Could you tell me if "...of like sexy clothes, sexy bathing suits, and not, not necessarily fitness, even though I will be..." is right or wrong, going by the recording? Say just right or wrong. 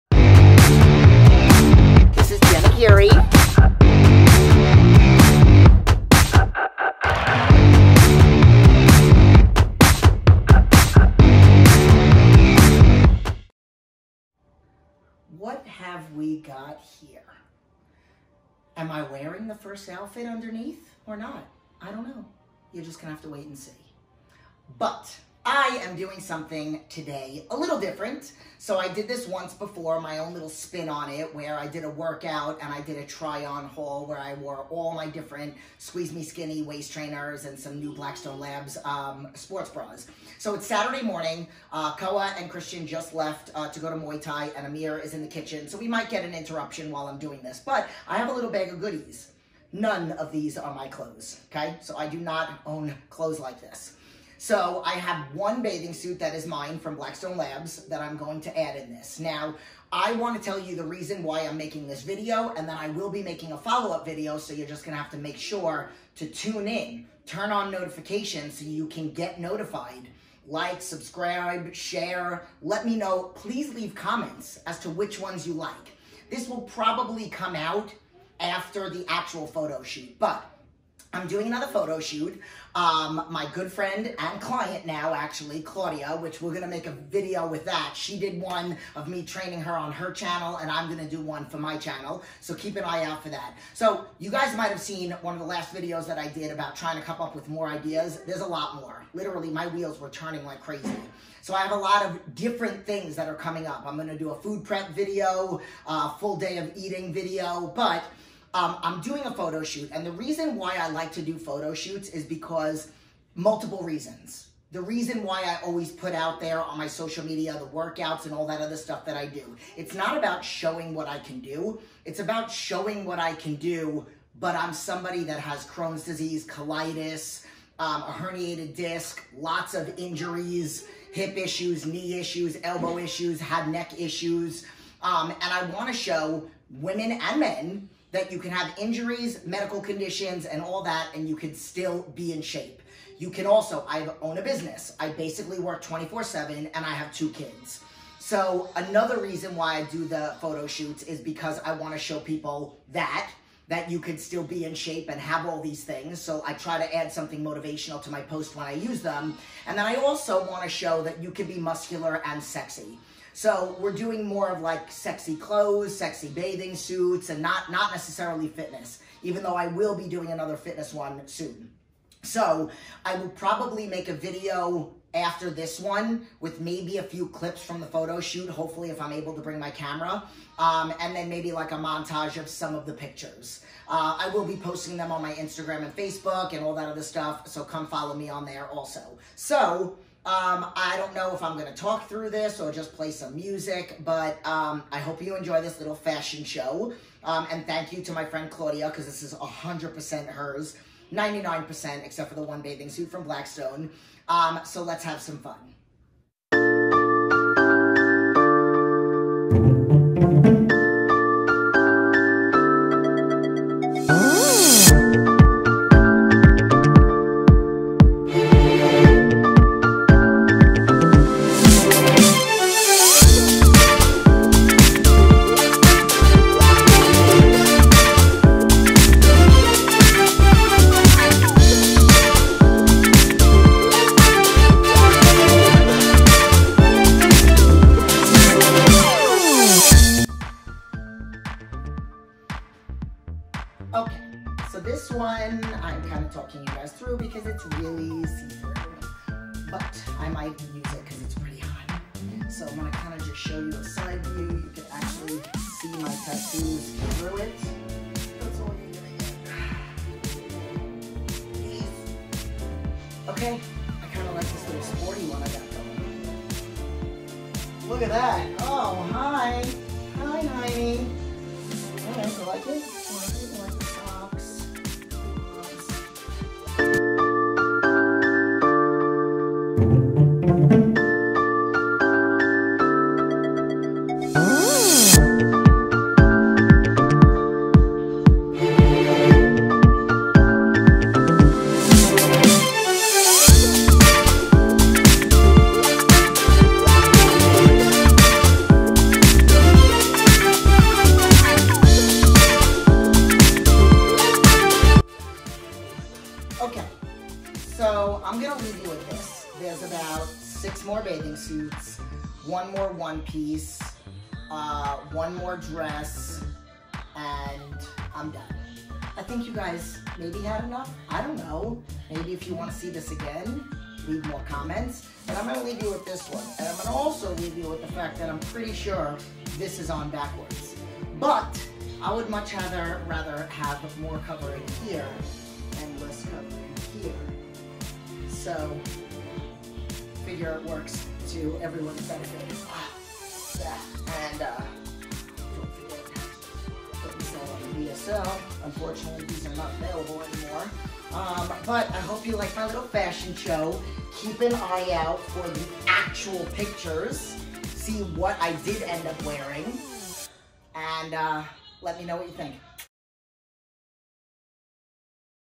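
right.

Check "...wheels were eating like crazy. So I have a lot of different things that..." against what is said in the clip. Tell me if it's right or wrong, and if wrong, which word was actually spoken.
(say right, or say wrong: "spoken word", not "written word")
wrong: "turning", not "eating".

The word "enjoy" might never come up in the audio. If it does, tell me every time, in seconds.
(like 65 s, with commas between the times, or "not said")
195 s.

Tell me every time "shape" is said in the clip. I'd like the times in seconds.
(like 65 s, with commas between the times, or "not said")
142 s, 154 s.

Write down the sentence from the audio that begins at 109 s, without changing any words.
And the reason why I like to do photo shoots is because multiple reasons.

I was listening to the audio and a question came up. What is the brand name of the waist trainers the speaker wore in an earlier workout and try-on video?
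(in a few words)
Squeeze Me Skinny.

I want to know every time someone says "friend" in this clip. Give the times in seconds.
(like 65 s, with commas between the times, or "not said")
83 s, 198 s.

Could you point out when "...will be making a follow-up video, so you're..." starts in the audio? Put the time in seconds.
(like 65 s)
62 s.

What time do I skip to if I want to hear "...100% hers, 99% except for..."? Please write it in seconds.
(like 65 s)
199 s.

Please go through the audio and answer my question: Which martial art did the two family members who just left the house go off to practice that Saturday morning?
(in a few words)
Muay Thai.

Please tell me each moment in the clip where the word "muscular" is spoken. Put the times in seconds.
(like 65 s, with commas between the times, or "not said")
161 s.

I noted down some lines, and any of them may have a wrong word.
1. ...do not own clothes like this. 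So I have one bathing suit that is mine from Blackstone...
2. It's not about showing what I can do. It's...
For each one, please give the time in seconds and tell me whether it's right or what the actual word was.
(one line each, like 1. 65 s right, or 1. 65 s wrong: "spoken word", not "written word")
1. 52 s right
2. 119 s right.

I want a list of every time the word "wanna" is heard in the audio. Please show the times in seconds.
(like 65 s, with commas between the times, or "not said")
135 s, 151 s, 160 s.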